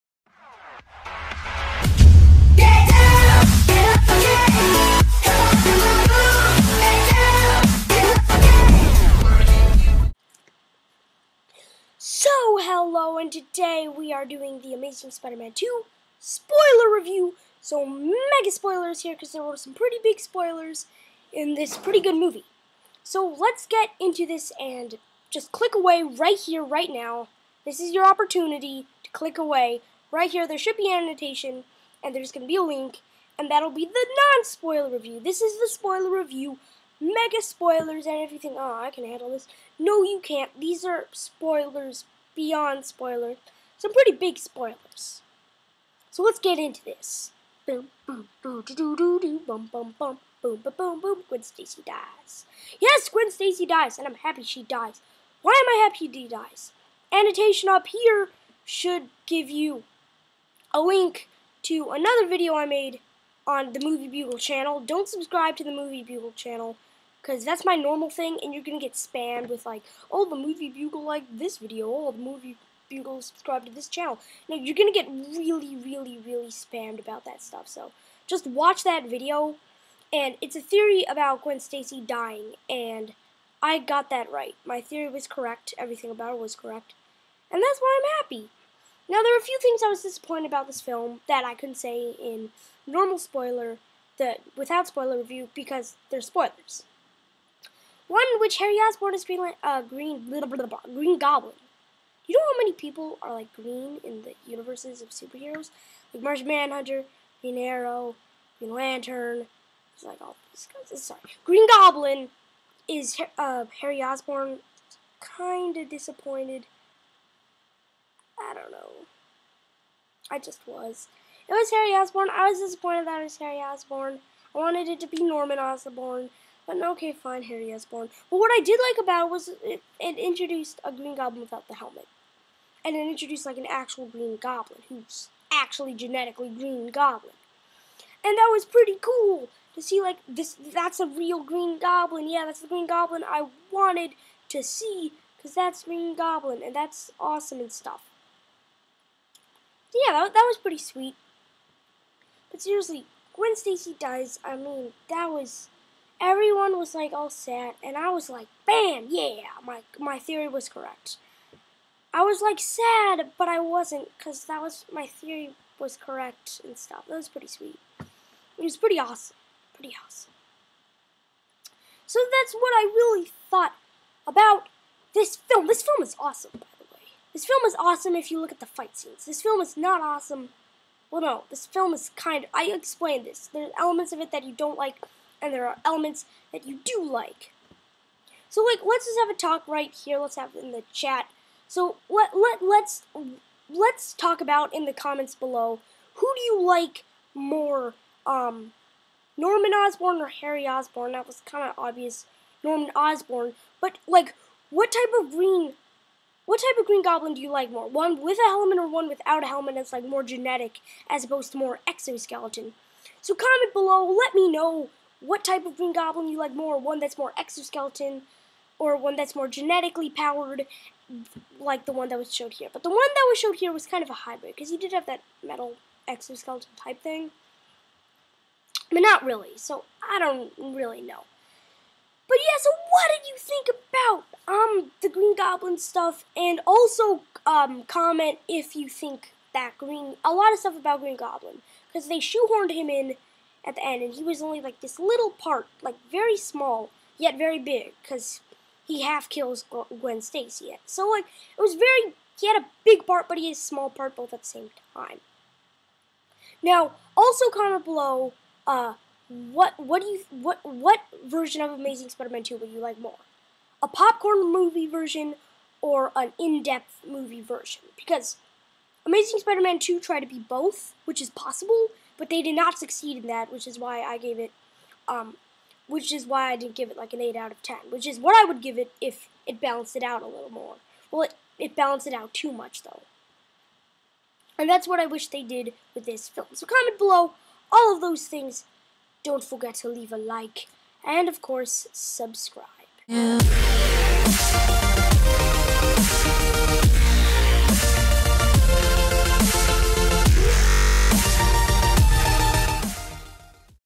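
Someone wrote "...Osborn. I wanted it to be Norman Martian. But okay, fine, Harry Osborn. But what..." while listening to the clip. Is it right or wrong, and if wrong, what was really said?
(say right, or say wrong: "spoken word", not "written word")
wrong: "Osborn", not "Martian".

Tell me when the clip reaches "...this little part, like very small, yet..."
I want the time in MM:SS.
04:04.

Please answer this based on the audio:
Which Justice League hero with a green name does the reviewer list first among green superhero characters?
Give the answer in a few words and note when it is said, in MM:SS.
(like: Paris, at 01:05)
Martian Manhunter, at 01:46.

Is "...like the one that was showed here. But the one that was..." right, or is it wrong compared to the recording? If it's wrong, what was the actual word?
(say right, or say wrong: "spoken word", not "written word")
right.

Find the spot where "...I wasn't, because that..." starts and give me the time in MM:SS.
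02:43.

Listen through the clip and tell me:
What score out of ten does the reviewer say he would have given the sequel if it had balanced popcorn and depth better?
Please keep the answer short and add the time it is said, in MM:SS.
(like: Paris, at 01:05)
8 out of 10, at 04:37.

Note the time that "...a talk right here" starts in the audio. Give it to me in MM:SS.
03:09.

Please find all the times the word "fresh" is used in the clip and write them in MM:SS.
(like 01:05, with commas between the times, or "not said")
not said.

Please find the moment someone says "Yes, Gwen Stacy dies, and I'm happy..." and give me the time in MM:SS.
00:52.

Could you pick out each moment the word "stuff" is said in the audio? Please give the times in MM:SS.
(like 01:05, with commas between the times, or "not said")
01:17, 02:27, 02:46, 03:55, 04:00.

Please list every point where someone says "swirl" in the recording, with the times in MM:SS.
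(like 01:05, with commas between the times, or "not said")
not said.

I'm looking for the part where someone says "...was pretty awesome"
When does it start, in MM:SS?
02:48.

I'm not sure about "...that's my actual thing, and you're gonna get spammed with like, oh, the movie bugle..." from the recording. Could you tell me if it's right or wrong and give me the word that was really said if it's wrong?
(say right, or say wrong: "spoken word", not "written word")
wrong: "normal", not "actual".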